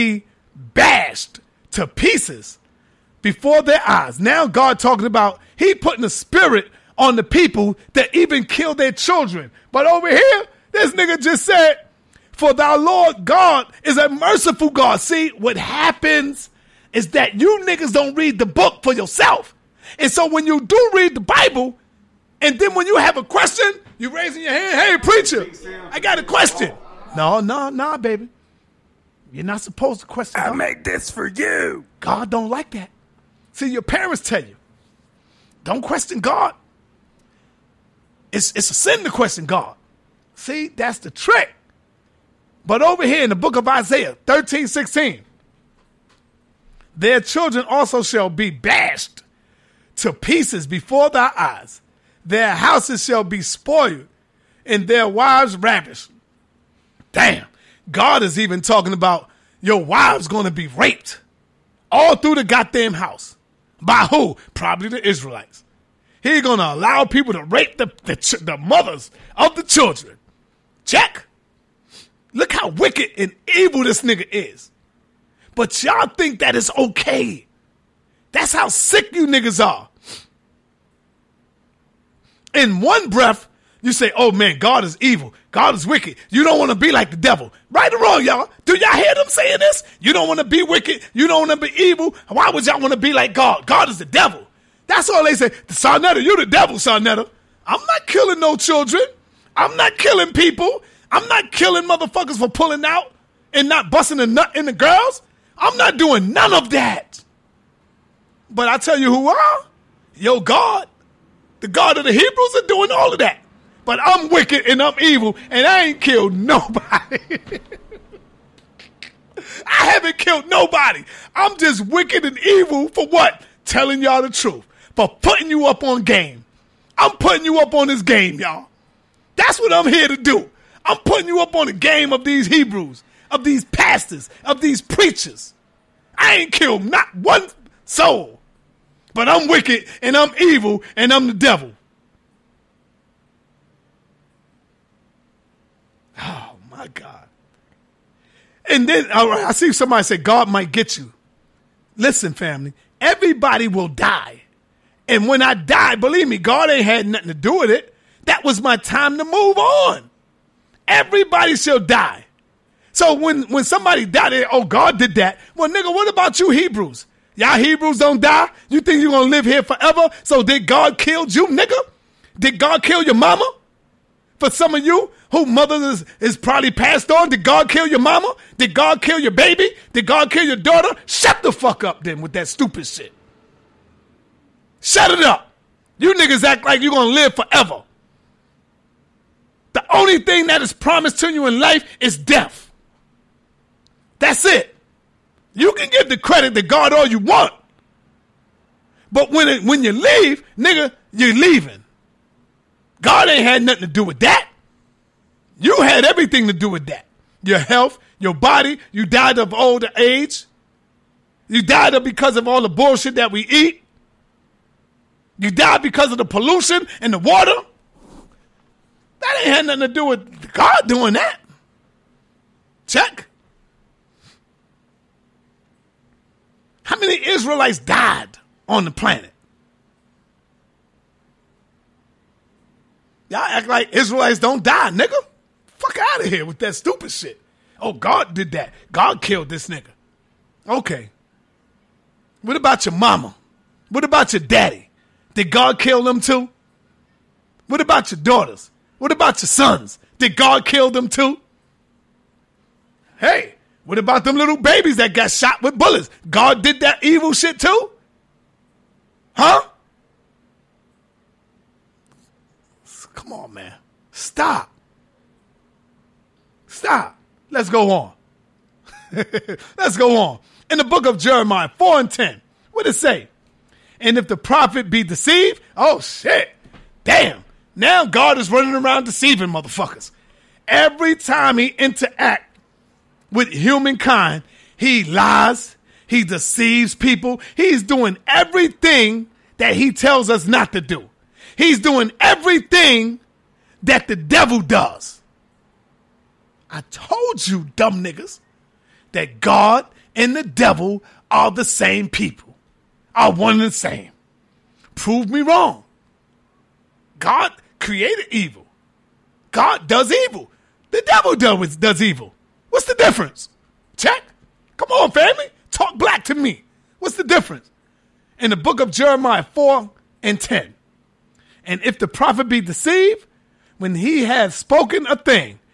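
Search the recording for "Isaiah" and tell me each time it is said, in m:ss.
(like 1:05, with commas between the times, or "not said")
0:43.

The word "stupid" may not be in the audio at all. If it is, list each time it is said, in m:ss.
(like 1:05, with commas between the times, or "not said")
3:02, 3:56.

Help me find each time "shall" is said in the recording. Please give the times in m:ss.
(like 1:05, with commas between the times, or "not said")
0:48, 0:53, 2:41.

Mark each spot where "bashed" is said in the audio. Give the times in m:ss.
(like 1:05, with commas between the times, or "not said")
0:00, 0:48.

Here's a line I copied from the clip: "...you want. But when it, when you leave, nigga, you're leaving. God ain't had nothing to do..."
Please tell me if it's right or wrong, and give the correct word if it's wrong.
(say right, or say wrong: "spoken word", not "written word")
right.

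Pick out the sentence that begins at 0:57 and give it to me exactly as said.
Damn, God is even talking about your wives going to be raped all through the goddamn house.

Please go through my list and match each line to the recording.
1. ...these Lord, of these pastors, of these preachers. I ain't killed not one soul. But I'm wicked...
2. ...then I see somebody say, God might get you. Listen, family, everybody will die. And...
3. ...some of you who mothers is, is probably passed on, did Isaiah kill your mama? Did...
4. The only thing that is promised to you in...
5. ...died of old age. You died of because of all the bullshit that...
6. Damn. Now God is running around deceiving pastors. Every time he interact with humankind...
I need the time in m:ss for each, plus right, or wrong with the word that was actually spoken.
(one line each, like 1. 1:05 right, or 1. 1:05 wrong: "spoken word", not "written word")
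1. 2:12 wrong: "Hebrews", not "Lord"
2. 2:28 right
3. 2:54 wrong: "God", not "Isaiah"
4. 3:09 right
5. 3:29 right
6. 4:37 wrong: "motherfuckers", not "pastors".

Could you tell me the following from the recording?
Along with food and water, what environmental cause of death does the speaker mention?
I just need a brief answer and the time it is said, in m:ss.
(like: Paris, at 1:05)
Pollution, at 3:36.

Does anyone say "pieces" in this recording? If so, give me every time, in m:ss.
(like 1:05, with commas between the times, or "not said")
0:01, 0:50.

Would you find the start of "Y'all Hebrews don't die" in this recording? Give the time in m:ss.
2:47.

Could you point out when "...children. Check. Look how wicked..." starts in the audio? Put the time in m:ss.
1:09.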